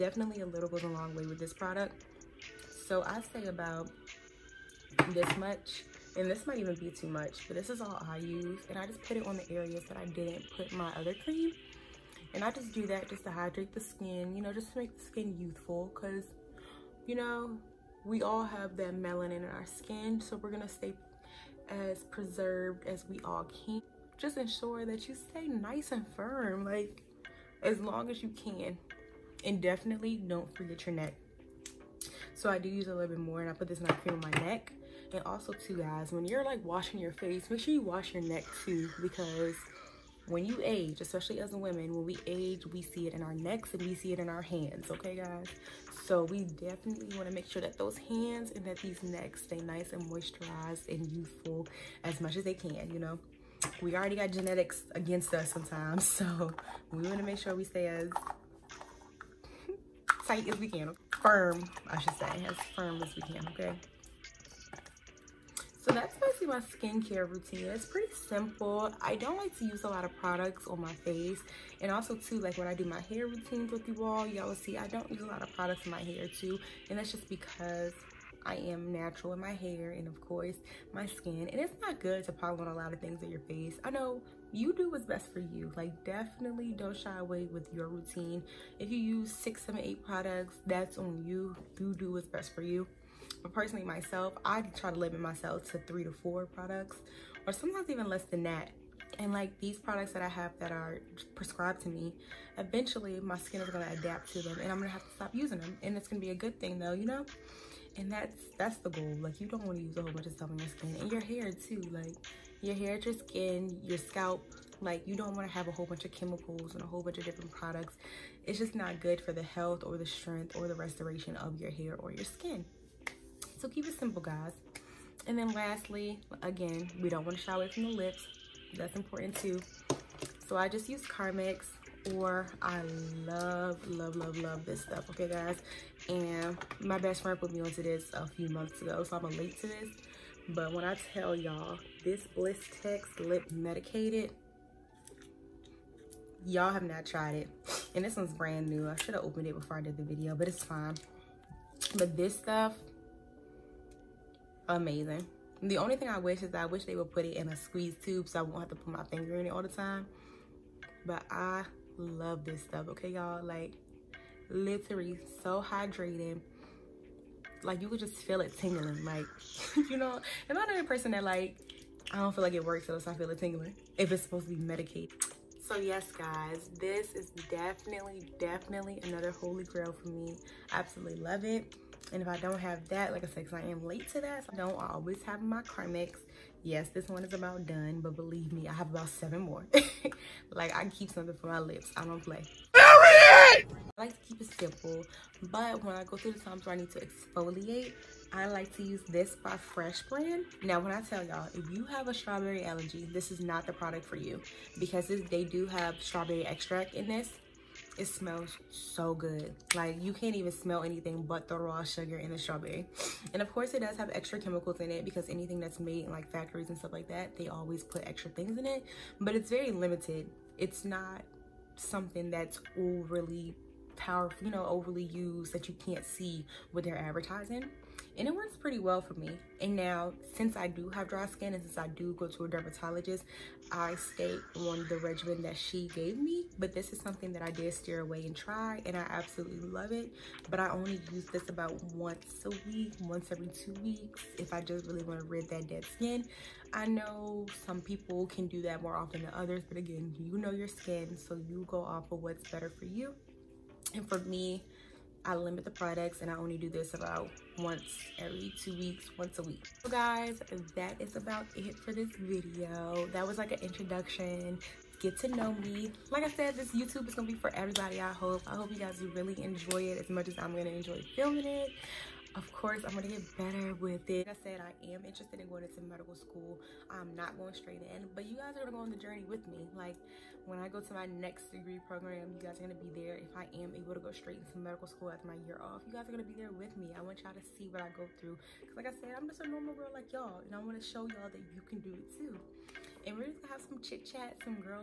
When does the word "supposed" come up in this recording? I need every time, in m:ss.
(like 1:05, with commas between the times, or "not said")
2:54.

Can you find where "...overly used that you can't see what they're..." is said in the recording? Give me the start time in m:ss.
3:44.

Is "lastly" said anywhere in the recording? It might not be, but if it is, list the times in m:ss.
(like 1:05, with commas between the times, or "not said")
2:05.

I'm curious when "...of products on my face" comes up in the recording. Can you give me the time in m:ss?
1:10.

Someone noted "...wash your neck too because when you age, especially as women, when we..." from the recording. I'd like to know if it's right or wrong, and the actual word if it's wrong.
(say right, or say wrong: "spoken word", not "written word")
right.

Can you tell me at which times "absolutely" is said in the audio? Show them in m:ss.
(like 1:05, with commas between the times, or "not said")
3:00, 3:59.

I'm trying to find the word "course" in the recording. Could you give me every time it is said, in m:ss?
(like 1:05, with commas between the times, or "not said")
1:20, 3:33, 4:32.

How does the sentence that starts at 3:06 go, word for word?
Yes, this one is about done, but believe me, I have about seven more.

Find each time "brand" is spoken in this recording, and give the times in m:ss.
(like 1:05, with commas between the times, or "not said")
2:28, 3:20.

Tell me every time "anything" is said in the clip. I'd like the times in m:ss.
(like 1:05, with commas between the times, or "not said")
3:30, 3:35.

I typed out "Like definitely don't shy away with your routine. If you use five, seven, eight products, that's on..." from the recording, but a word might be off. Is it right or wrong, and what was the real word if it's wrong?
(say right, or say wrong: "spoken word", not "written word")
wrong: "six", not "five".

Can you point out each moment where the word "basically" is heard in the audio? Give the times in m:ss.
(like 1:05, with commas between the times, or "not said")
1:06.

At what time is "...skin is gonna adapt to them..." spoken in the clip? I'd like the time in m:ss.
1:43.